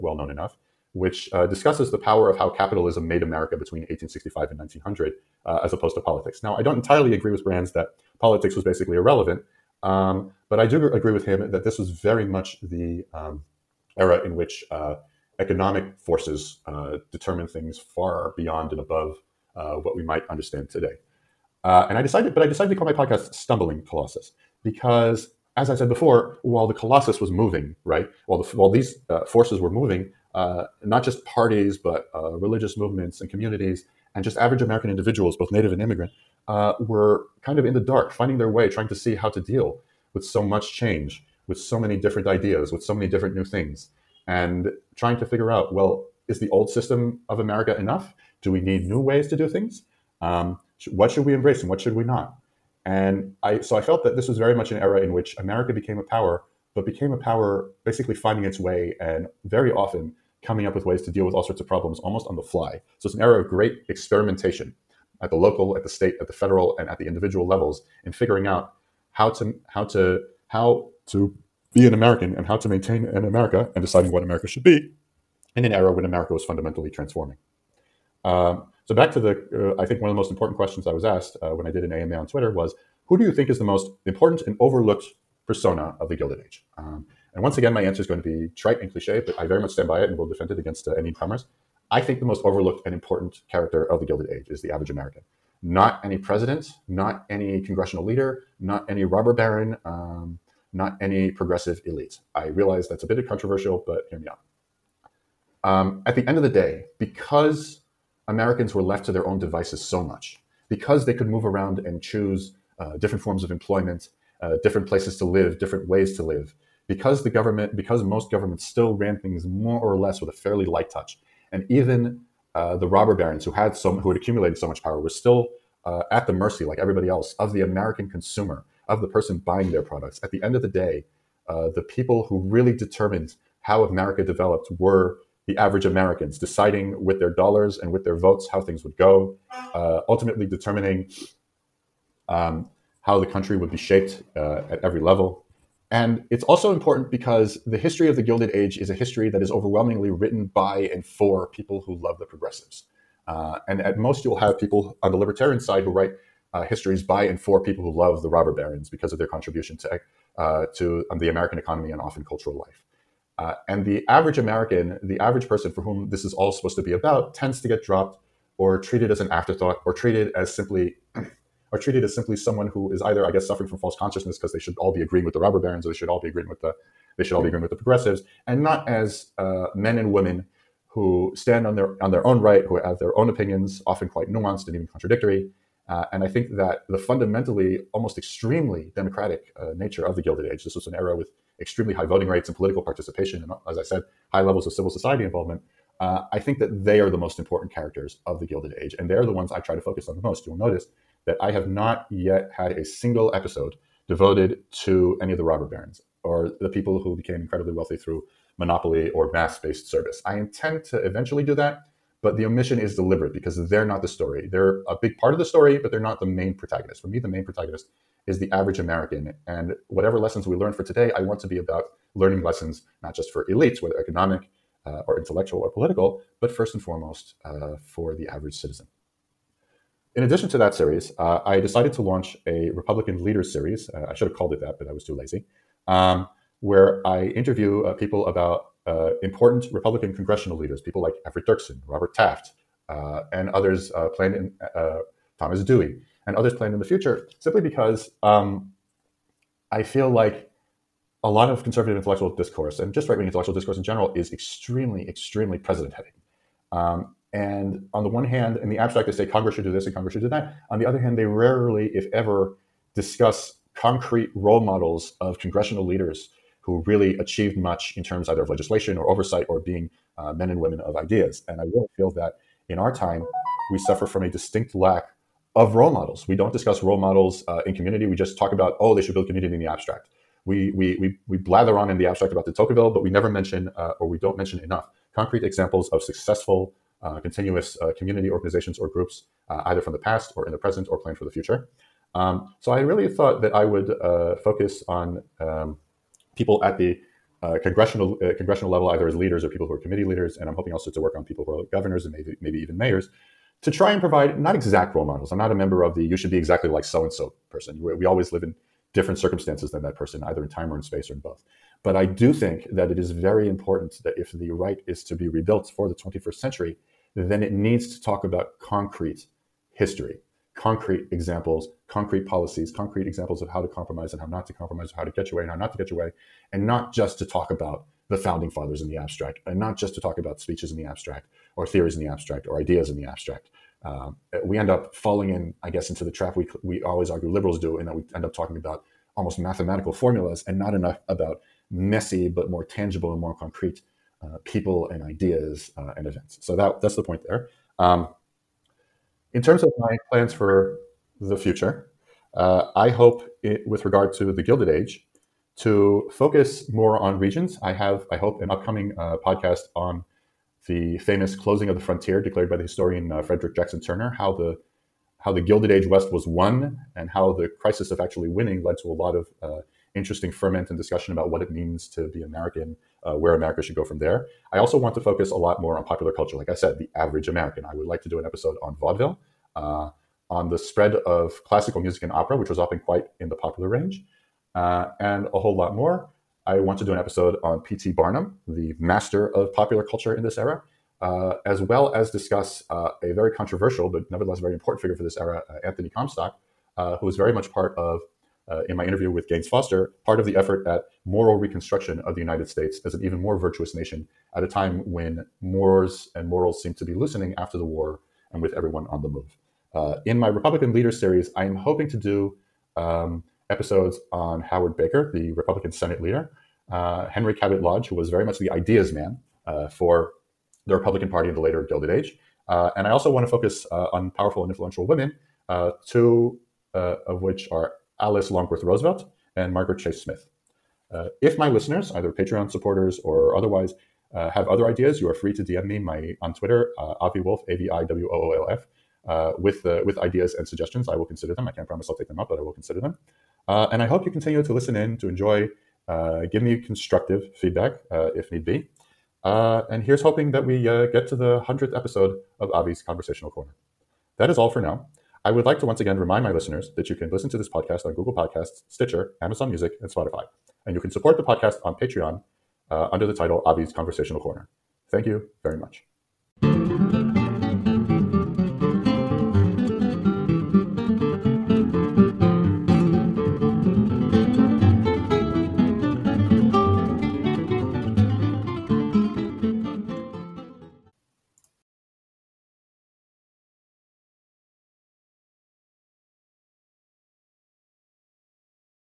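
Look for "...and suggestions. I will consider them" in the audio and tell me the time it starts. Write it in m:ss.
7:20.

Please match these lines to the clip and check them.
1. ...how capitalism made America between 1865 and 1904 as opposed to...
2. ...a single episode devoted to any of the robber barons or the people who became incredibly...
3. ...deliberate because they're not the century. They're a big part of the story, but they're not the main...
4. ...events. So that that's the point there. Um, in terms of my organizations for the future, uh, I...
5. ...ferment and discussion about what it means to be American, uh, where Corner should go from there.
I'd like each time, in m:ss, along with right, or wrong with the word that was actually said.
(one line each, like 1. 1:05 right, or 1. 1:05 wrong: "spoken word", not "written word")
1. 0:02 wrong: "1900", not "1904"
2. 3:22 right
3. 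3:32 wrong: "story", not "century"
4. 5:46 wrong: "plans", not "organizations"
5. 6:10 wrong: "America", not "Corner".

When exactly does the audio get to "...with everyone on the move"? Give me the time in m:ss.
6:48.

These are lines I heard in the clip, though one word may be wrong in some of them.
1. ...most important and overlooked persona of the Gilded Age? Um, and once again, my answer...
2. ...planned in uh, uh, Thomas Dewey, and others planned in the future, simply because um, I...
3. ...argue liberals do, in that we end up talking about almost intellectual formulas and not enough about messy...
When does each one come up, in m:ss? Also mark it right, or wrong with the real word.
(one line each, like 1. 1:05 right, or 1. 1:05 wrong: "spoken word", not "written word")
1. 1:23 right
2. 4:04 right
3. 5:37 wrong: "mathematical", not "intellectual".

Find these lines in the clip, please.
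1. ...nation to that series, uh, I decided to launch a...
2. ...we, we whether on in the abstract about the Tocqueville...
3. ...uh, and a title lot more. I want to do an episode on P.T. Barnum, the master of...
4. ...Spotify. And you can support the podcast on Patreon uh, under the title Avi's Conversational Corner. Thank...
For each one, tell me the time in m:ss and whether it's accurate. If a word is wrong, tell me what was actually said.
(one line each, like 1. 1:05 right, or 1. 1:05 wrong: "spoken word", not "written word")
1. 3:50 wrong: "addition", not "nation"
2. 4:40 wrong: "blather", not "whether"
3. 6:24 wrong: "whole", not "title"
4. 7:39 right.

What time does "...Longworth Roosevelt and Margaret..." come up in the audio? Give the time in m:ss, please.
7:08.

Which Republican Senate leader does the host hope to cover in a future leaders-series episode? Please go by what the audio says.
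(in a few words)
Howard Baker.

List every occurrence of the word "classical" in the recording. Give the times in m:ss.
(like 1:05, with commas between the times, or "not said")
6:21.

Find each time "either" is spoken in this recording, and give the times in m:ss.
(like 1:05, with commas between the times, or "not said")
2:53, 4:28, 4:49, 4:58, 5:10, 7:11.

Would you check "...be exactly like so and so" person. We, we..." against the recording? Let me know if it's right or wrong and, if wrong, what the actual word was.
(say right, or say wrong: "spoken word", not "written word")
right.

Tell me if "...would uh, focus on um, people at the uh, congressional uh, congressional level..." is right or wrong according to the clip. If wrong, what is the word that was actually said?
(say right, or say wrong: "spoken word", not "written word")
right.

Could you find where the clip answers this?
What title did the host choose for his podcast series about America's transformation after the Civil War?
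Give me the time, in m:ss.
0:23.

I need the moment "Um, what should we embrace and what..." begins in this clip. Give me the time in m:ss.
0:50.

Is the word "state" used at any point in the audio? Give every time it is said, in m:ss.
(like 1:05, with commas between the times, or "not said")
1:05, 6:42.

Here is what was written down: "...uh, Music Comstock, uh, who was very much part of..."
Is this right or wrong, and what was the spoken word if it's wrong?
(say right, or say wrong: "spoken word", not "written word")
wrong: "Anthony", not "Music".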